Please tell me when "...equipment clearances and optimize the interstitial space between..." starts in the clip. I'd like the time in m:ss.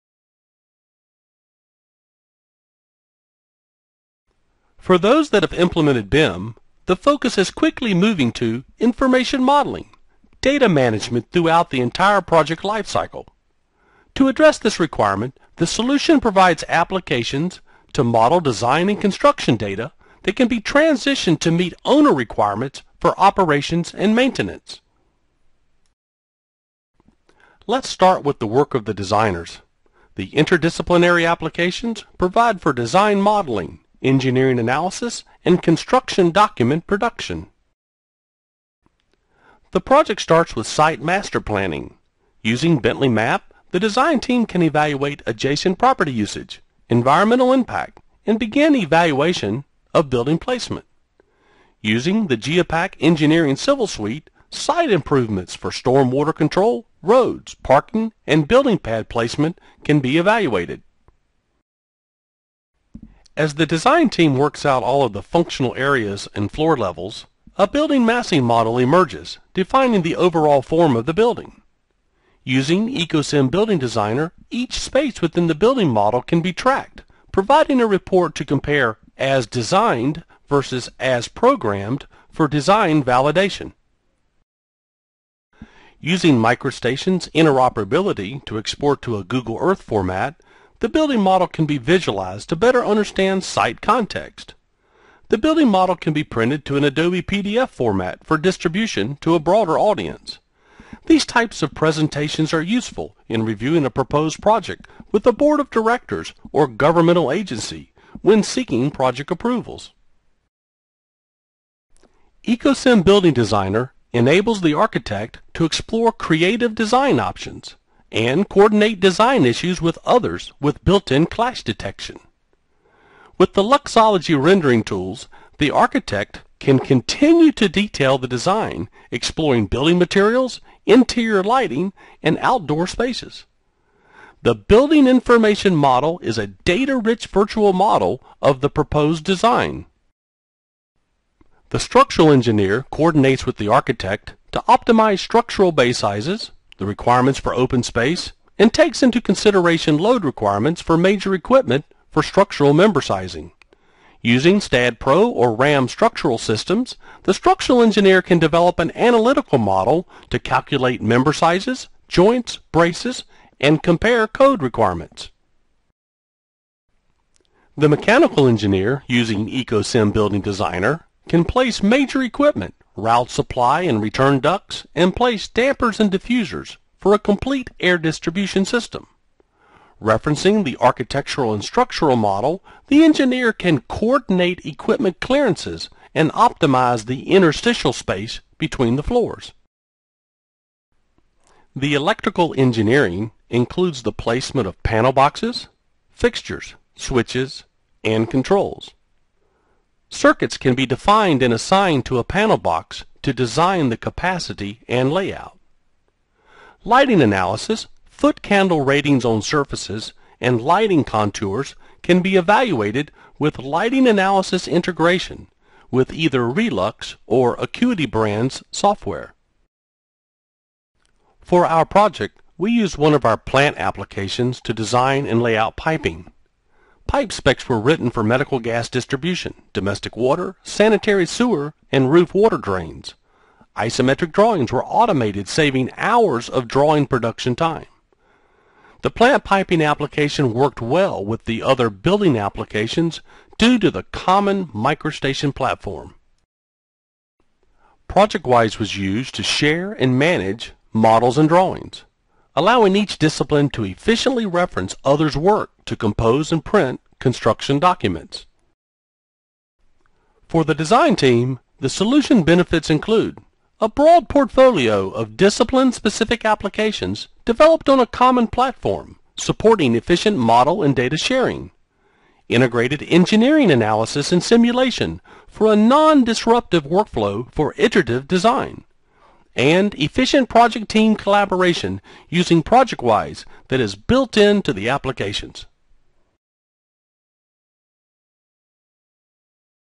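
3:04.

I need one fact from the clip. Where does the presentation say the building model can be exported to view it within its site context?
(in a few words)
Google Earth.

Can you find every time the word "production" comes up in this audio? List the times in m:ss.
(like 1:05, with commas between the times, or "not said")
0:36, 3:57.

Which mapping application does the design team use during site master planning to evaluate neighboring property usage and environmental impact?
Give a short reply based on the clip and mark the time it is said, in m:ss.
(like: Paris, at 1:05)
Bentley Map, at 0:42.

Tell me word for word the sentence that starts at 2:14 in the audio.
The Building Information Model is a data-rich virtual model of the proposed design.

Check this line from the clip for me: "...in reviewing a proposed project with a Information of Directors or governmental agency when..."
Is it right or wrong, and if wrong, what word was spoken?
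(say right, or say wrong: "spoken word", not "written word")
wrong: "Board", not "Information".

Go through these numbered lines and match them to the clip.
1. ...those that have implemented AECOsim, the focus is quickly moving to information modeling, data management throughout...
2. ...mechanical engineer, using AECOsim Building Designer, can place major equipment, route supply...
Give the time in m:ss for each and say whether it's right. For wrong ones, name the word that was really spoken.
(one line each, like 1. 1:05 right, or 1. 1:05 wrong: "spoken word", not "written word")
1. 0:04 wrong: "BIM", not "AECOsim"
2. 2:47 right.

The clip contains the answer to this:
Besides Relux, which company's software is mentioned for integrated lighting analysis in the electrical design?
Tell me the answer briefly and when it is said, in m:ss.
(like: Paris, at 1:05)
Acuity Brands, at 3:37.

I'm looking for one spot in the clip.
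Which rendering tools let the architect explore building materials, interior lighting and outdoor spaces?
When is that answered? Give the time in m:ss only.
2:03.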